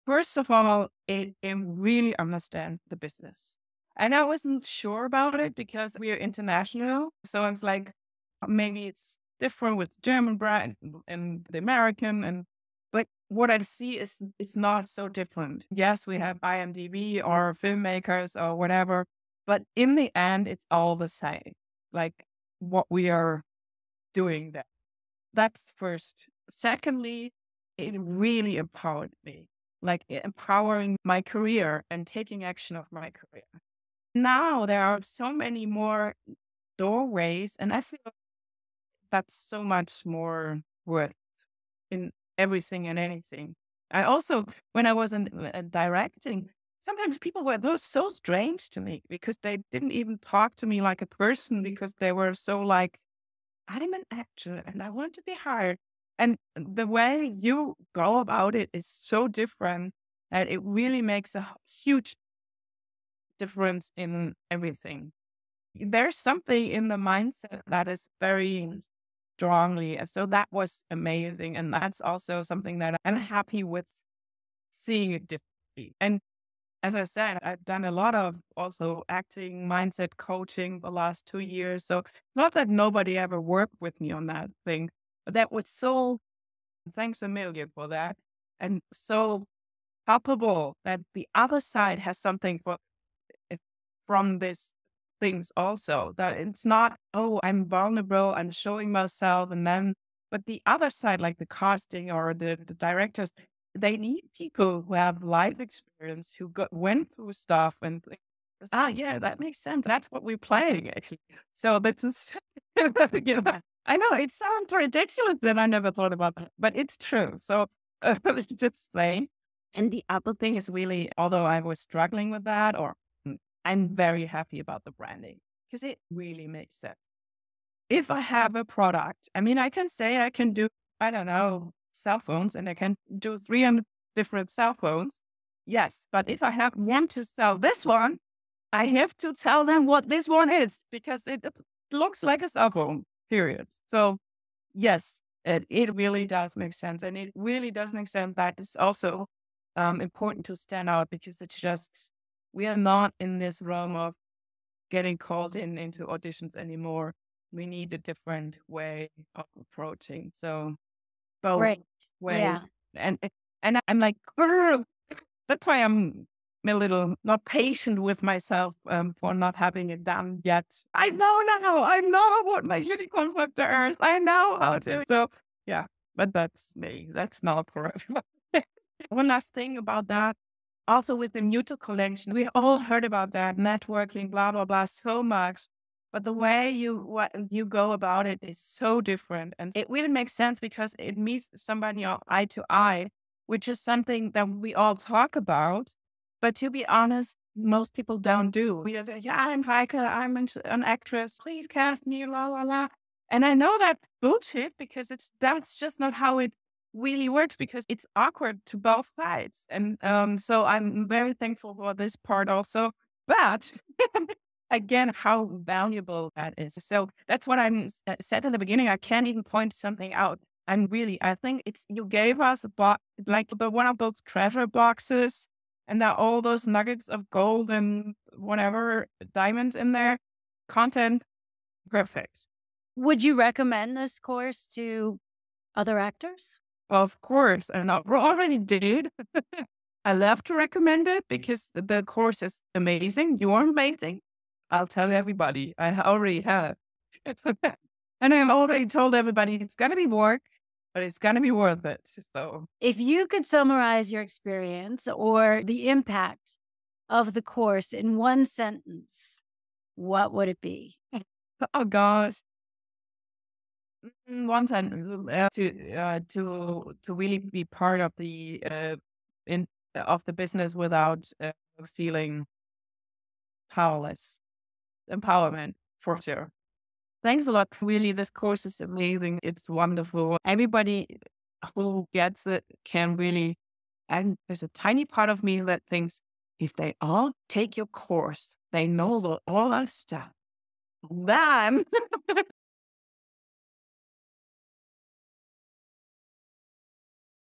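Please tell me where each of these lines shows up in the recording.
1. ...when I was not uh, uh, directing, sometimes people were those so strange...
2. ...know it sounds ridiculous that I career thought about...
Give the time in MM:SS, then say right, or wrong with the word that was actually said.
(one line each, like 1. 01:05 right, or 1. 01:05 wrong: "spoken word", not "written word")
1. 00:44 right
2. 01:53 wrong: "never", not "career".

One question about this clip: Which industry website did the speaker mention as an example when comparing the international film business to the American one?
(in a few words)
IMDb.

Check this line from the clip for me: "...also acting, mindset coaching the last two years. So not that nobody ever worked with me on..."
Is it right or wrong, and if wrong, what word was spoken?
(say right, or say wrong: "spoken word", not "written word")
right.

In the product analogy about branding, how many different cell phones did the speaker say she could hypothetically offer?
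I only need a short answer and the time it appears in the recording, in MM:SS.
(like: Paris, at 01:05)
300, at 02:13.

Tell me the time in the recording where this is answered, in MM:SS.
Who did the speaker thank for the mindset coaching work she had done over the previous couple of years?
01:27.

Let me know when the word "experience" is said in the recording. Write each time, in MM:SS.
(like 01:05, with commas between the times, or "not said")
01:45, 04:14.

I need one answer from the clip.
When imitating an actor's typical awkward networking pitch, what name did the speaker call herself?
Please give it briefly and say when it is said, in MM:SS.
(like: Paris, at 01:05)
Heike, at 03:19.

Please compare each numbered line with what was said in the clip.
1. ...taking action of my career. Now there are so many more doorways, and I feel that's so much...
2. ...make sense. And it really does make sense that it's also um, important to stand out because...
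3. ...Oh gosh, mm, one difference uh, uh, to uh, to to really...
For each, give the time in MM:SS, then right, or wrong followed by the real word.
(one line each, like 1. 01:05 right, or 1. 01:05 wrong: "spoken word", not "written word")
1. 00:32 right
2. 02:26 right
3. 04:21 wrong: "sentence", not "difference".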